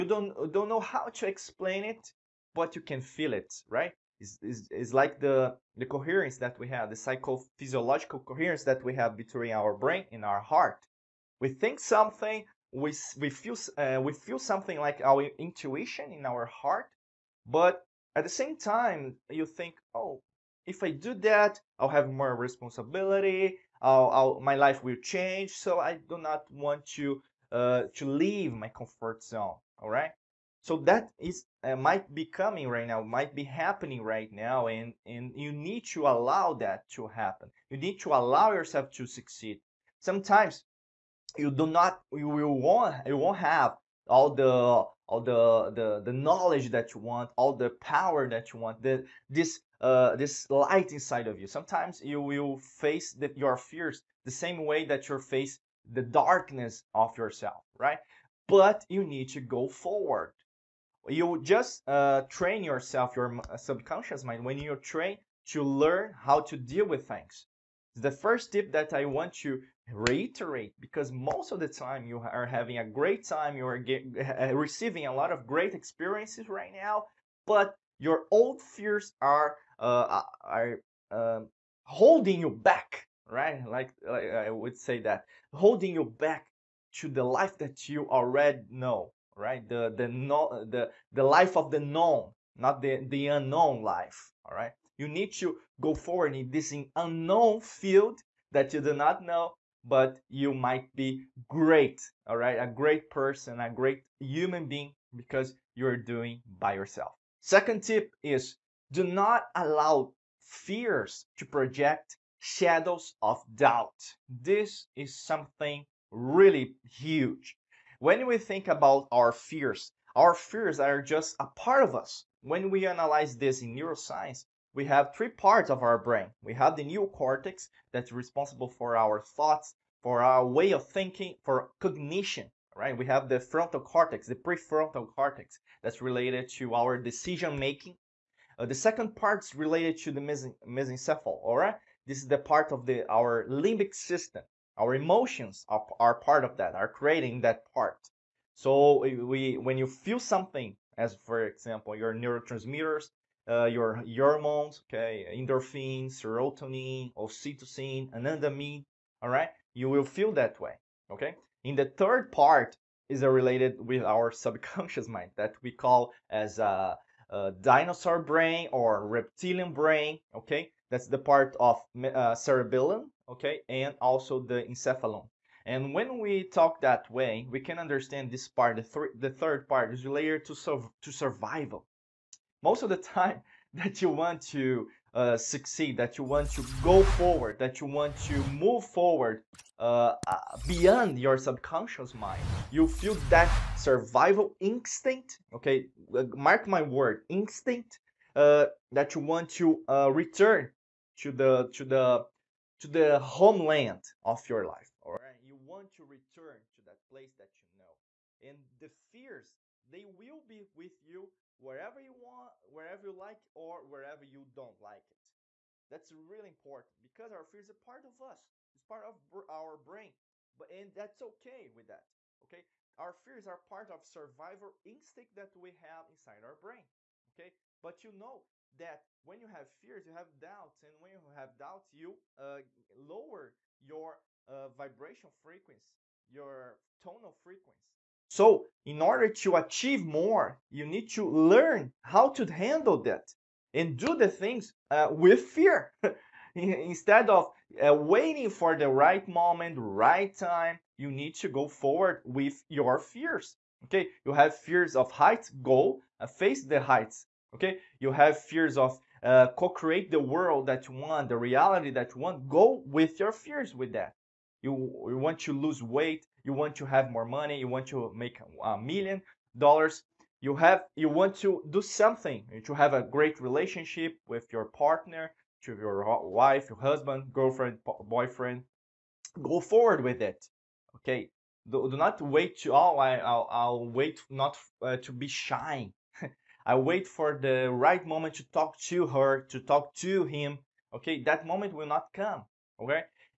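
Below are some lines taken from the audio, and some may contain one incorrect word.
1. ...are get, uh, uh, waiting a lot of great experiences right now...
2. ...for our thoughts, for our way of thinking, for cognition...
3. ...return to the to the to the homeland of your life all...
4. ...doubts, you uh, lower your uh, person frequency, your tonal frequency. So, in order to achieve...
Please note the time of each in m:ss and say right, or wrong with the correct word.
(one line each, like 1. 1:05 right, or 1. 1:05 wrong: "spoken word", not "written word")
1. 1:13 wrong: "receiving", not "waiting"
2. 2:08 right
3. 3:20 right
4. 3:51 wrong: "vibration", not "person".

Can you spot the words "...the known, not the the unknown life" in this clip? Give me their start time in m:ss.
1:31.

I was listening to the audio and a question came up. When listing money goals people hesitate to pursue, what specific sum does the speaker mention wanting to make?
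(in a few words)
a million dollars.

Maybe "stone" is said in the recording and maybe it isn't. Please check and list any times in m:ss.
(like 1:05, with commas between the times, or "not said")
not said.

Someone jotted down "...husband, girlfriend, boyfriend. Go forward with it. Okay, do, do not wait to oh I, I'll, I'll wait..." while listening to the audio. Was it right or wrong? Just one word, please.
right.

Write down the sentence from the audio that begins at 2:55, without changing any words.
And when we talk that way, we can understand this part, the, th the third part is related to, sur to survival.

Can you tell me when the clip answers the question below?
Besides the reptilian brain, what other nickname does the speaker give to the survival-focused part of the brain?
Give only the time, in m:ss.
2:47.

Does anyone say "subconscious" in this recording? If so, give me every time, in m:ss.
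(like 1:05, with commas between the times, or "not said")
1:03, 2:44, 3:11.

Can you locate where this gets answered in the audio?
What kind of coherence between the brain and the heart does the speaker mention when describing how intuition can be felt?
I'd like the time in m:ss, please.
0:06.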